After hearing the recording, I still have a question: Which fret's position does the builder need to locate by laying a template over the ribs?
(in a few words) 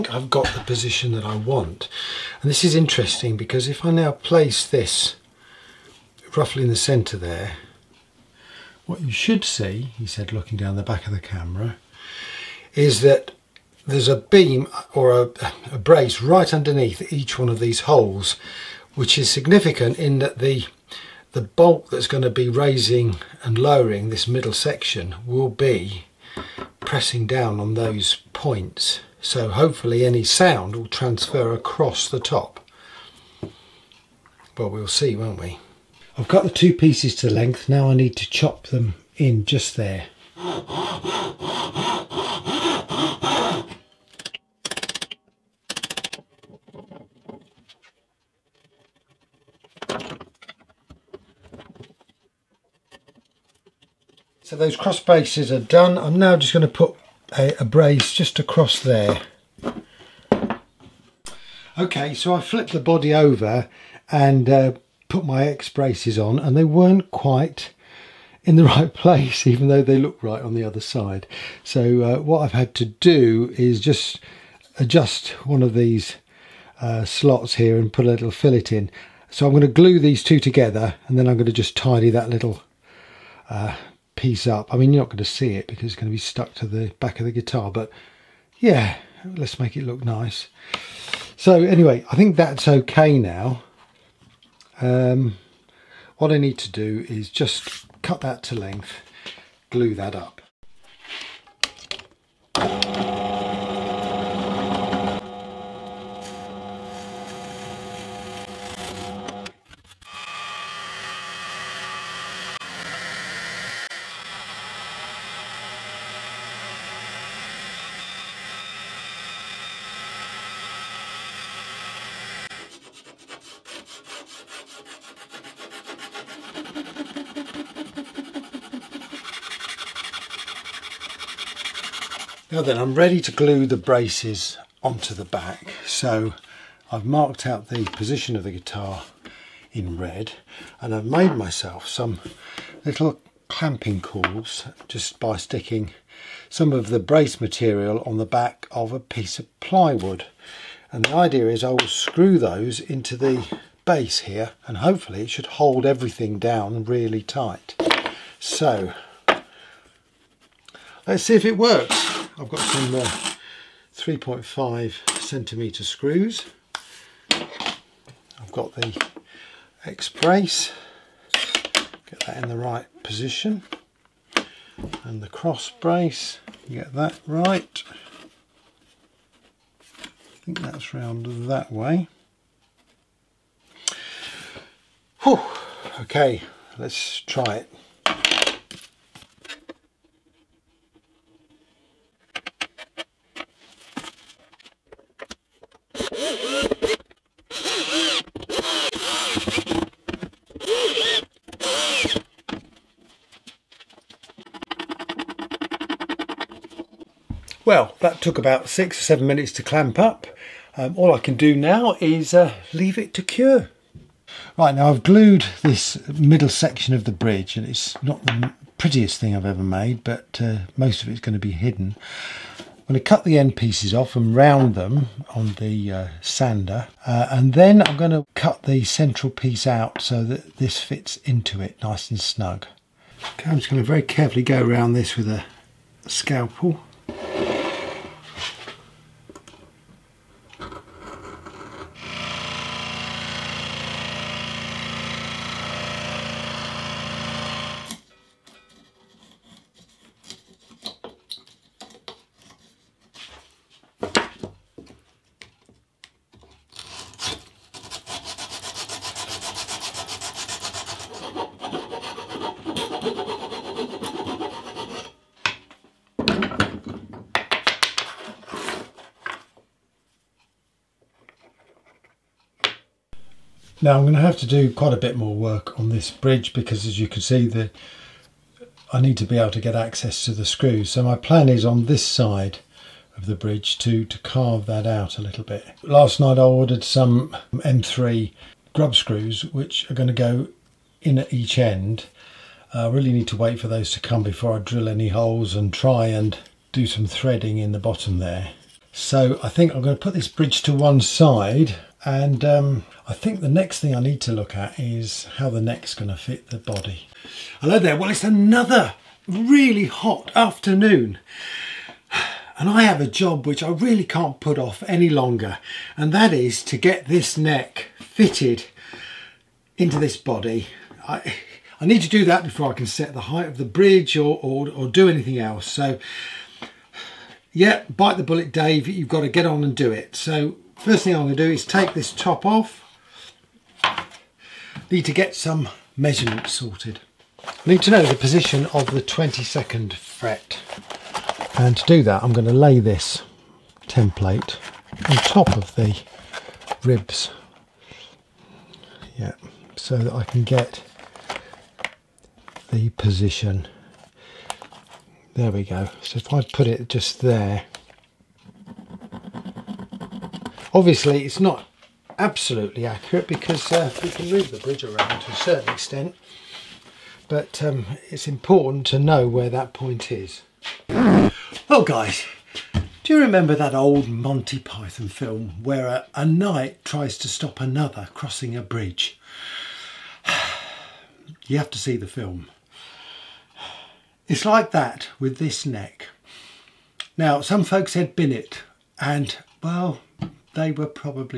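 22nd fret.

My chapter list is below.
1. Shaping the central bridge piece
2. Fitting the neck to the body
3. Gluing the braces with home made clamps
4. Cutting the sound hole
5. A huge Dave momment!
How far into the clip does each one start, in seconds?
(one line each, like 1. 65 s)
1. 213 s
2. 308 s
3. 128 s
4. 93 s
5. 373 s.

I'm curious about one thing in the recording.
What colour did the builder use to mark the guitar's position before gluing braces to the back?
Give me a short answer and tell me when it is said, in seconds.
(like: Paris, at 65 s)
red, at 139 s.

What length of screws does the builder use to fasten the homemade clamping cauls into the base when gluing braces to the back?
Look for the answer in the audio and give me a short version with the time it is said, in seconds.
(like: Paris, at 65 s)
3.5 centimeters, at 163 s.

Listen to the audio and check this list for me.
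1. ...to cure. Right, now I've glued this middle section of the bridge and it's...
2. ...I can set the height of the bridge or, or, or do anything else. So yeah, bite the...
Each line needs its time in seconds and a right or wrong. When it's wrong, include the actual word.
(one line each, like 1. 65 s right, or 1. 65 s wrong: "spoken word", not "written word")
1. 213 s right
2. 322 s right.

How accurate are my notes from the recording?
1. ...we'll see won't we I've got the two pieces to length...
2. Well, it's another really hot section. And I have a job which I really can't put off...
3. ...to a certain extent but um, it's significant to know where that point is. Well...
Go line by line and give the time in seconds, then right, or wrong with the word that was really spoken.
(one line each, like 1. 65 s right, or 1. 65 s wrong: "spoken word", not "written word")
1. 34 s right
2. 307 s wrong: "afternoon", not "section"
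3. 365 s wrong: "important", not "significant".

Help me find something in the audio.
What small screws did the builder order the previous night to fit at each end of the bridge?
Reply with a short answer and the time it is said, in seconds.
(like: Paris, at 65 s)
M3 grub screws, at 287 s.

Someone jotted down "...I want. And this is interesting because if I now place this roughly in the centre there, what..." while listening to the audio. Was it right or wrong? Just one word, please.
right.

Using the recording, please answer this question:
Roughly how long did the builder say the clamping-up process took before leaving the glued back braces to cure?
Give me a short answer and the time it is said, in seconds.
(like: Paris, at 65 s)
six or seven minutes, at 208 s.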